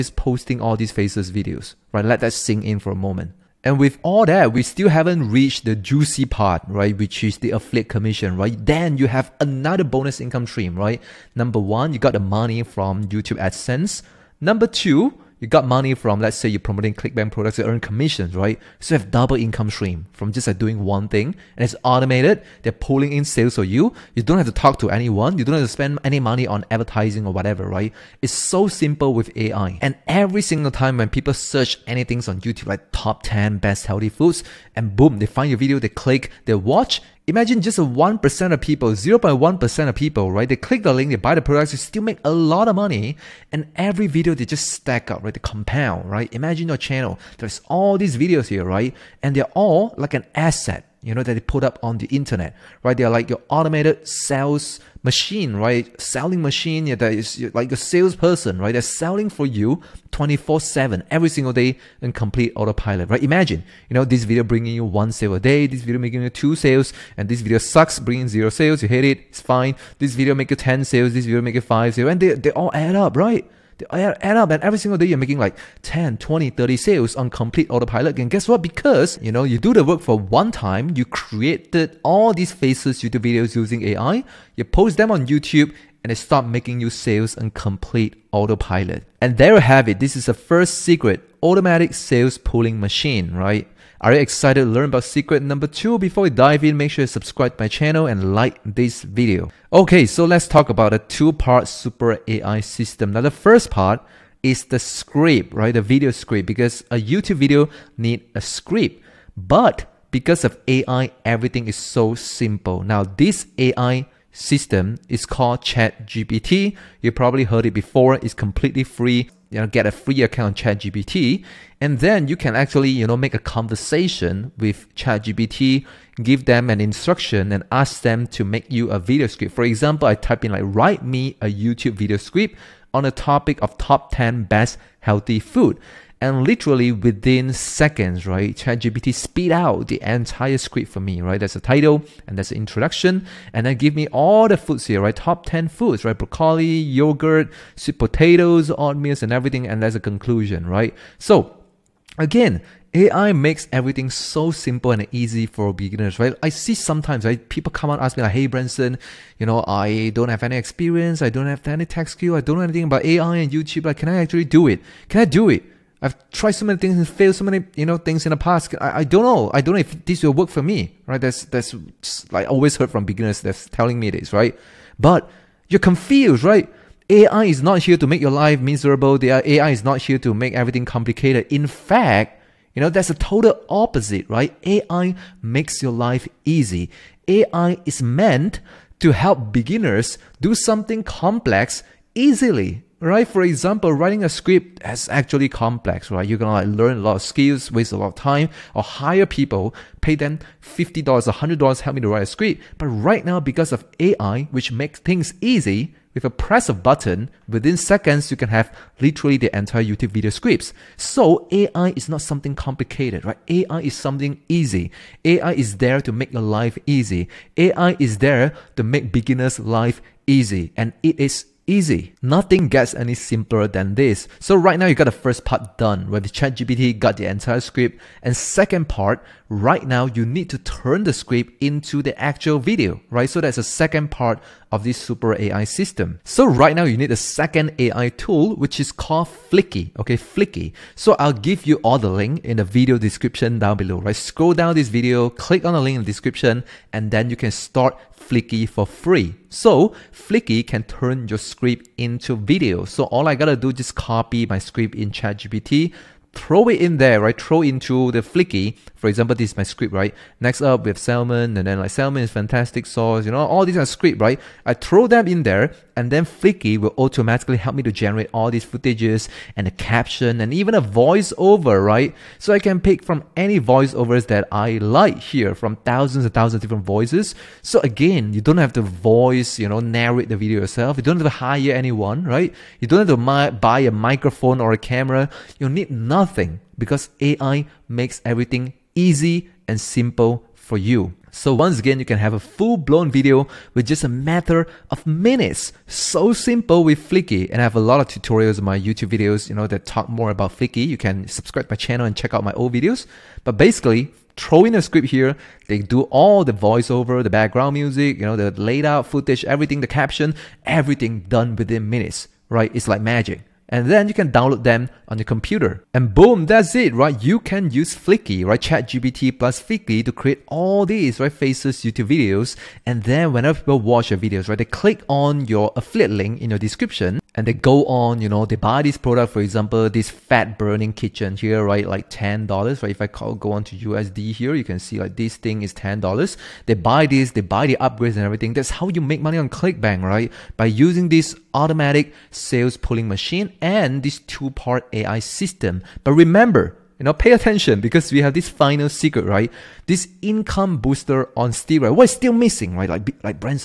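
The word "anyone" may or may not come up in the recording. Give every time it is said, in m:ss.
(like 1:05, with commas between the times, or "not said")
0:24, 4:41.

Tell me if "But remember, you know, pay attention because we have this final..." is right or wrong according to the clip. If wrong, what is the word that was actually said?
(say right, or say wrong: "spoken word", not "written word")
right.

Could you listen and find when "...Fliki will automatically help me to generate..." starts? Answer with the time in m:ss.
4:26.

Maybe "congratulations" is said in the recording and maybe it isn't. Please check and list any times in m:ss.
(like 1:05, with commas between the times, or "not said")
not said.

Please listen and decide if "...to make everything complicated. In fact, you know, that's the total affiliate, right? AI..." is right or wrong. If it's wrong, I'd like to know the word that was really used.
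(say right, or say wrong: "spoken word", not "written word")
wrong: "opposite", not "affiliate".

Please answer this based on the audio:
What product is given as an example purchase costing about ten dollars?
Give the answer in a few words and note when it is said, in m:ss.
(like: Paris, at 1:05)
fat burning kitchen, at 5:30.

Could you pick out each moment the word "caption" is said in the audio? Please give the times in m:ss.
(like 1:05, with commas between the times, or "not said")
4:29, 5:09.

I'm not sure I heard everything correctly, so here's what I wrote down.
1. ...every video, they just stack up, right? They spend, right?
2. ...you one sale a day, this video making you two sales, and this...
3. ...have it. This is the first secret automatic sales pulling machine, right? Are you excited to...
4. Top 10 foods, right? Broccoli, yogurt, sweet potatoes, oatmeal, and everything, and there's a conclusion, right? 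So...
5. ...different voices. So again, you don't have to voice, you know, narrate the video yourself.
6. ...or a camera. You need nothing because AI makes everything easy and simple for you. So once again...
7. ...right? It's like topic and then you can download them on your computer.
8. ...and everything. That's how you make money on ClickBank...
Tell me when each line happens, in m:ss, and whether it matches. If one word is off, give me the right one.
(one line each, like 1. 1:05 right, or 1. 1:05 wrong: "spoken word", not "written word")
1. 0:43 wrong: "compound", not "spend"
2. 1:04 right
3. 1:29 right
4. 2:25 right
5. 4:36 right
6. 4:44 right
7. 5:12 wrong: "magic", not "topic"
8. 5:38 right.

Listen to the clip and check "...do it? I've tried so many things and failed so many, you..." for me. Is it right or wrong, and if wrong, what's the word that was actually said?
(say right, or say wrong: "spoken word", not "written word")
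right.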